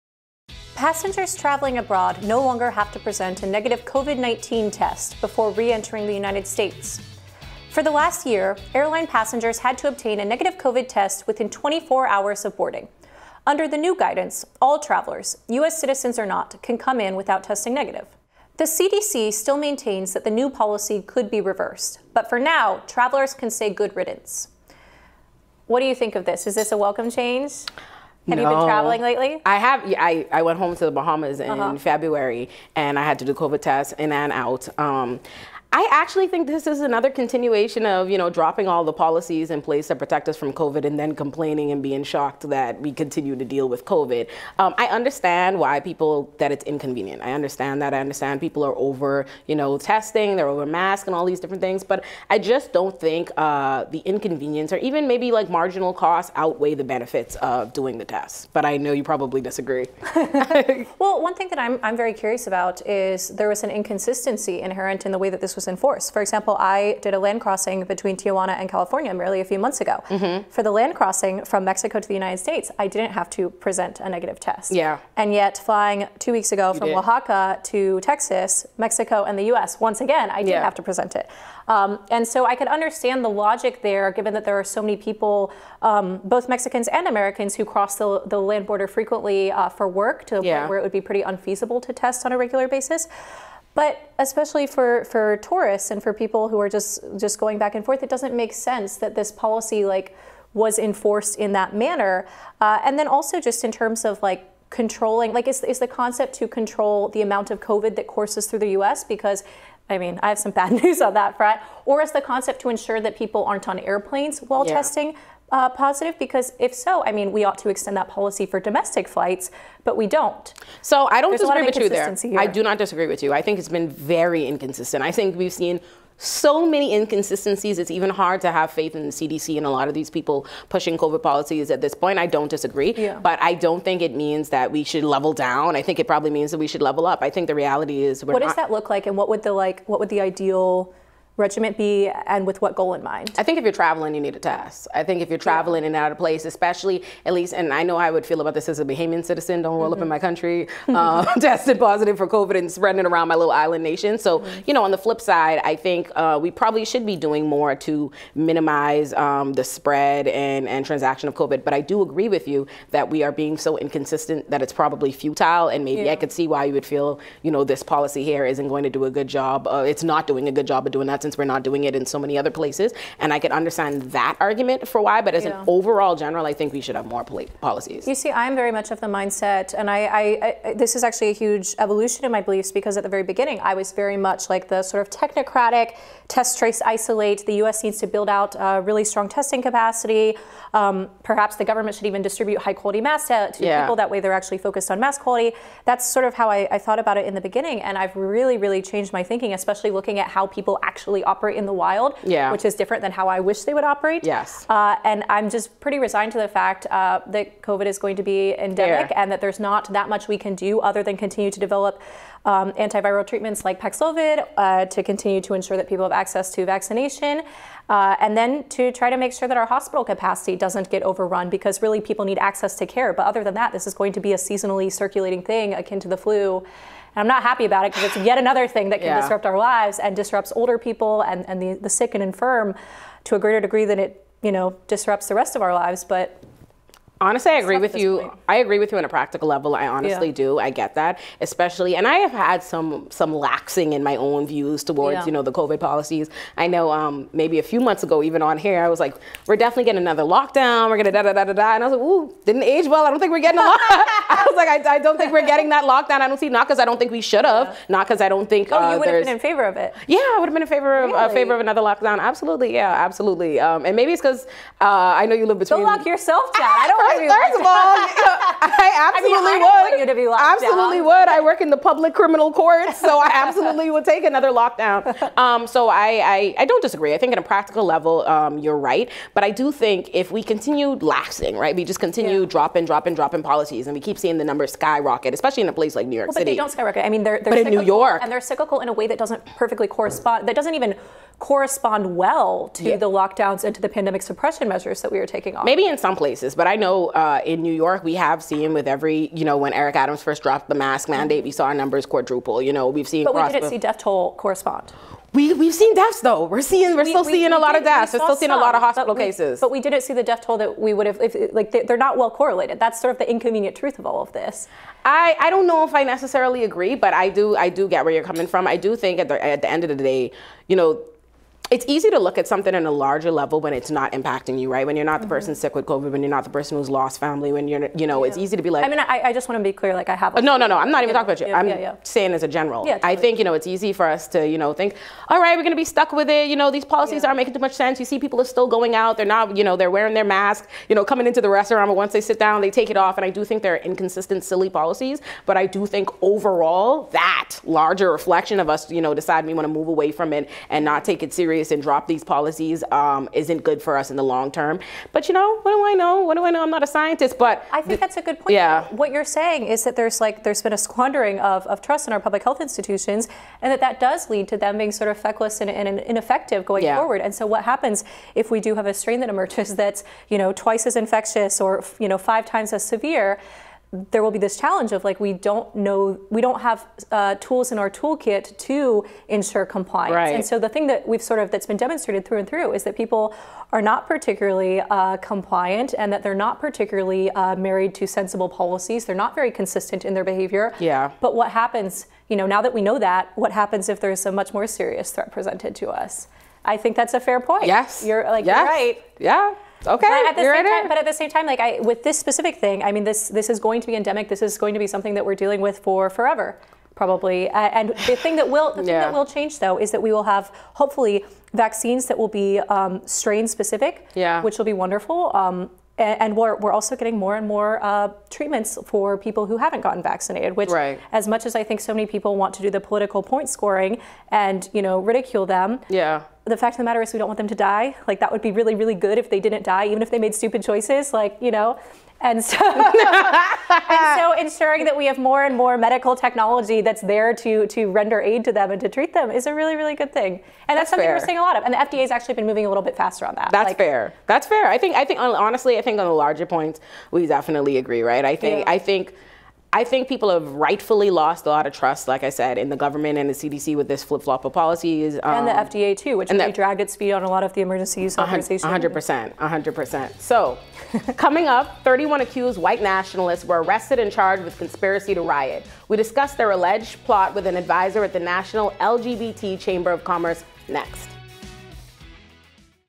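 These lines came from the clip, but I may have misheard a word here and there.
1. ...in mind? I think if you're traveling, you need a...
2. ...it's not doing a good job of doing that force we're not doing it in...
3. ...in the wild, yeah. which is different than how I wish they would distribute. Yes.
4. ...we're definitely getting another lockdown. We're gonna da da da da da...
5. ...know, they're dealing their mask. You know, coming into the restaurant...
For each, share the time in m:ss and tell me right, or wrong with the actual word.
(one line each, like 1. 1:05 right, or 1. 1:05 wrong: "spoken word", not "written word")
1. 2:22 right
2. 2:49 wrong: "since", not "force"
3. 3:21 wrong: "operate", not "distribute"
4. 4:09 right
5. 5:39 wrong: "wearing", not "dealing".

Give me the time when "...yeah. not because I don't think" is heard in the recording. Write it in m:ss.
4:17.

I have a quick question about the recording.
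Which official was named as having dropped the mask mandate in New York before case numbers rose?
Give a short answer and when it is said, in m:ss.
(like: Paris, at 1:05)
Eric Adams, at 4:59.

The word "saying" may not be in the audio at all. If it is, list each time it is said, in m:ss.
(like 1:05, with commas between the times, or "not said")
5:32, 5:59.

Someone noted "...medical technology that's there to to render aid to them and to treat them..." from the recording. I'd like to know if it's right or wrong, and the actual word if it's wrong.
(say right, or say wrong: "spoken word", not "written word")
right.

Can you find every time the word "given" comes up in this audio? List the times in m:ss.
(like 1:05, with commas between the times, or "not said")
1:24.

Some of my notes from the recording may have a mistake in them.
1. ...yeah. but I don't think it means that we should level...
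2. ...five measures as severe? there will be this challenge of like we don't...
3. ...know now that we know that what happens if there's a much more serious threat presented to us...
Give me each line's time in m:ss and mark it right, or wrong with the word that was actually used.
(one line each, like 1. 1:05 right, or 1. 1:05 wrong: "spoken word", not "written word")
1. 2:12 right
2. 6:12 wrong: "times", not "measures"
3. 6:32 right.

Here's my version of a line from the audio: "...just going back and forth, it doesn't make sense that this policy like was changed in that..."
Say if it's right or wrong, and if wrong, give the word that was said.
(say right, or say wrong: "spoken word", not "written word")
wrong: "enforced", not "changed".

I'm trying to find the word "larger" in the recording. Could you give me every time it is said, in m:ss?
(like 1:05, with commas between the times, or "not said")
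5:22, 5:47, 7:26.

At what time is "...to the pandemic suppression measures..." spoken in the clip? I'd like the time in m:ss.
4:53.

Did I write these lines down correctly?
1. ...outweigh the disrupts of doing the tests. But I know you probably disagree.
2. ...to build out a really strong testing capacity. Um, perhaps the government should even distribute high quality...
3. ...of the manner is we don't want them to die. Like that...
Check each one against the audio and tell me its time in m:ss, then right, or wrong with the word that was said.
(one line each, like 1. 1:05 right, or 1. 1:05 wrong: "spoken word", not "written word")
1. 0:56 wrong: "benefits", not "disrupts"
2. 3:07 right
3. 7:06 wrong: "matter", not "manner".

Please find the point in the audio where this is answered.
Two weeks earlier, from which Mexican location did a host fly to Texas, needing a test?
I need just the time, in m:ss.
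1:16.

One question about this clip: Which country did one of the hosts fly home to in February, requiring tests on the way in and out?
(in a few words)
The Bahamas.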